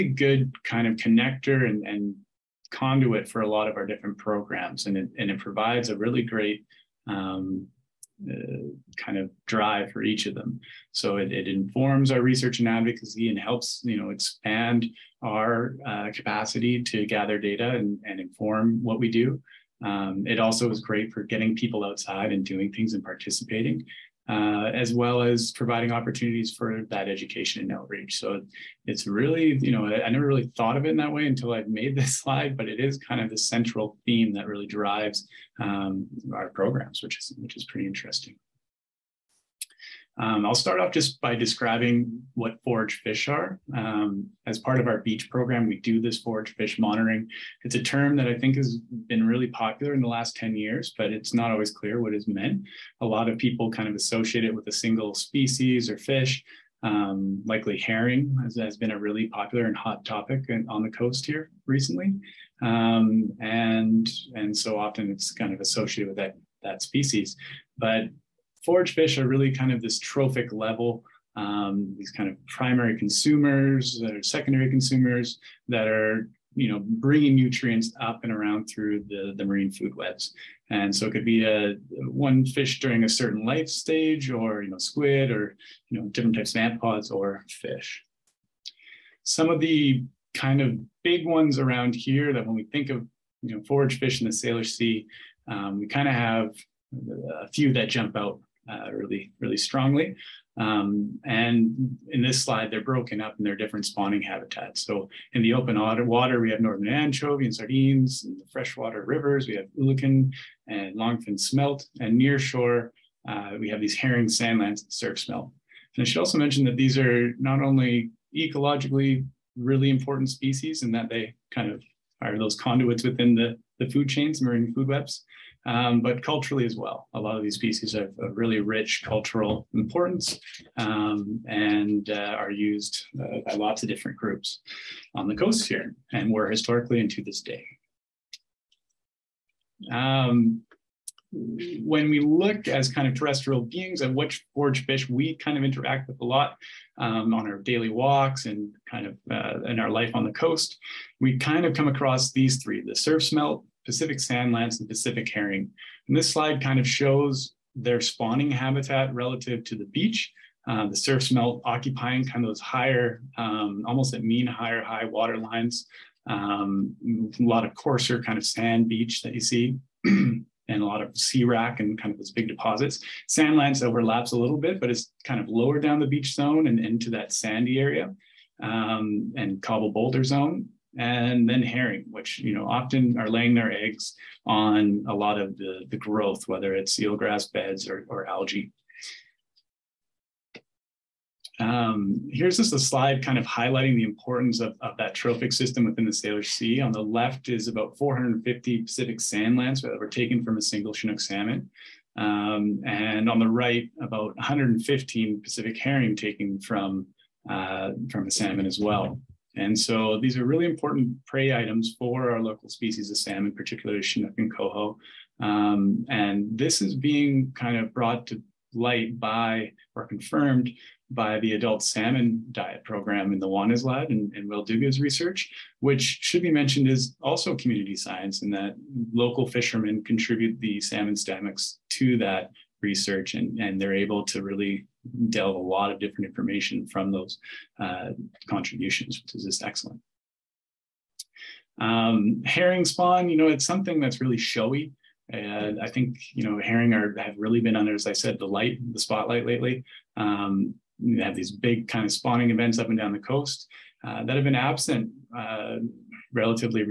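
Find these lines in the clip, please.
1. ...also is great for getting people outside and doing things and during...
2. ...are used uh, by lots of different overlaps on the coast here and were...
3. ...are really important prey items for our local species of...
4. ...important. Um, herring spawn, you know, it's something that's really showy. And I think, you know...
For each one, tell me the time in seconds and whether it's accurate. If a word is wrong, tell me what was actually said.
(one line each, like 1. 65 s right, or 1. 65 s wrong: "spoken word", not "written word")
1. 20 s wrong: "participating", not "during"
2. 132 s wrong: "groups", not "overlaps"
3. 210 s right
4. 239 s wrong: "excellent", not "important".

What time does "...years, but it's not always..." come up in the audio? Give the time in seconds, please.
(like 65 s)
50 s.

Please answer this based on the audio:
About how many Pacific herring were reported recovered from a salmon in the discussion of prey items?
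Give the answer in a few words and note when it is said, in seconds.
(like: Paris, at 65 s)
115, at 204 s.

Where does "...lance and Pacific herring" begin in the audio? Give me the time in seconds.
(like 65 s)
154 s.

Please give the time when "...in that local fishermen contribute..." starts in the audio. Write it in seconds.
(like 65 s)
228 s.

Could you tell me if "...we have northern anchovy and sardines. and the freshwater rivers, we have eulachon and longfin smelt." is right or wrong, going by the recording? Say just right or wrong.
right.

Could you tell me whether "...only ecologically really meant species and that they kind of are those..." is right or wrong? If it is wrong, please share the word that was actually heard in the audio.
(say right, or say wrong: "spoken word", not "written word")
wrong: "important", not "meant".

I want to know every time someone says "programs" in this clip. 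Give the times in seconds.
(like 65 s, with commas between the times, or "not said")
4 s, 36 s, 45 s, 222 s.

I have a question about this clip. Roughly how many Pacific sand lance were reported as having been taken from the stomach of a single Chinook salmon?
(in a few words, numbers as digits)
450.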